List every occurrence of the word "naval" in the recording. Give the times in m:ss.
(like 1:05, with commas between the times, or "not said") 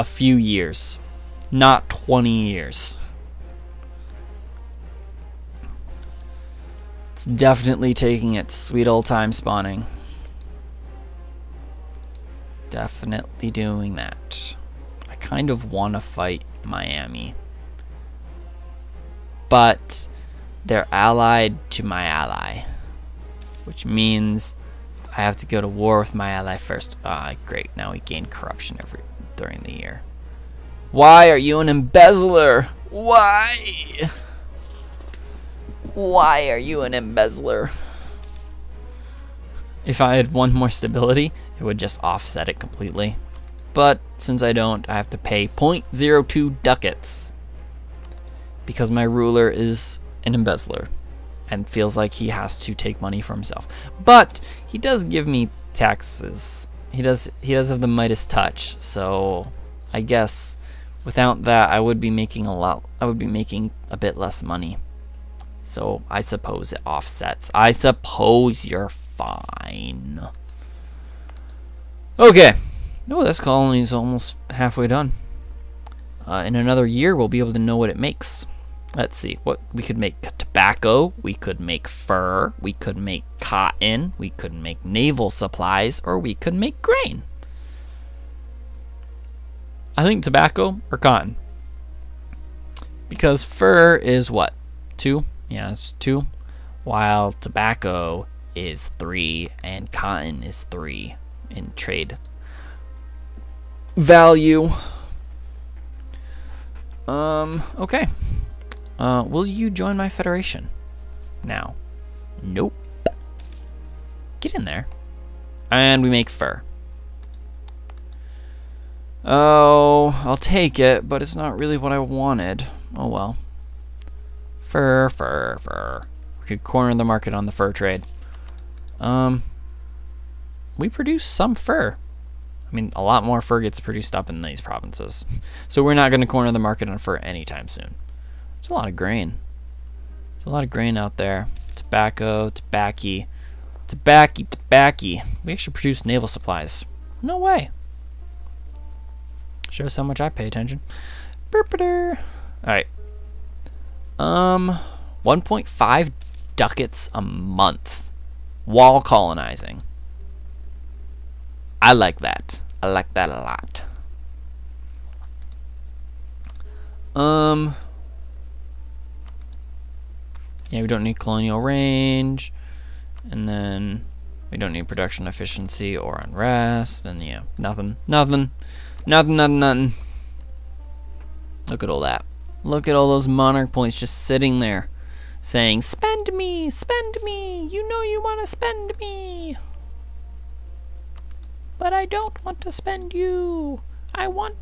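1:24, 2:26.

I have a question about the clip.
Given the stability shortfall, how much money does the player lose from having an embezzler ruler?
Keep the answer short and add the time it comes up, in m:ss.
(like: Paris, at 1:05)
0.02 ducats, at 0:45.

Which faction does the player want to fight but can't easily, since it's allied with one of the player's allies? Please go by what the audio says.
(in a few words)
Miami.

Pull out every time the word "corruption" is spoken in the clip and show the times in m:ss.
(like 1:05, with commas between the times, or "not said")
0:28.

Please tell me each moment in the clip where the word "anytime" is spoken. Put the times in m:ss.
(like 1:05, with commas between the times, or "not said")
2:17.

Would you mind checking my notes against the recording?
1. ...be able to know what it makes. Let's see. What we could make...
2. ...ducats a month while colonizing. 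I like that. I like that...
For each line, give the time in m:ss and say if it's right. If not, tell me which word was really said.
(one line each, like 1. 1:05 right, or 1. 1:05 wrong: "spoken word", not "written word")
1. 1:17 right
2. 2:36 right.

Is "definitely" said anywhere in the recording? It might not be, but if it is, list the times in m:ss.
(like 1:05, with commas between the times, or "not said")
0:07, 0:12.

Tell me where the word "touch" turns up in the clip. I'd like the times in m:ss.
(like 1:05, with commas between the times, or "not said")
0:58.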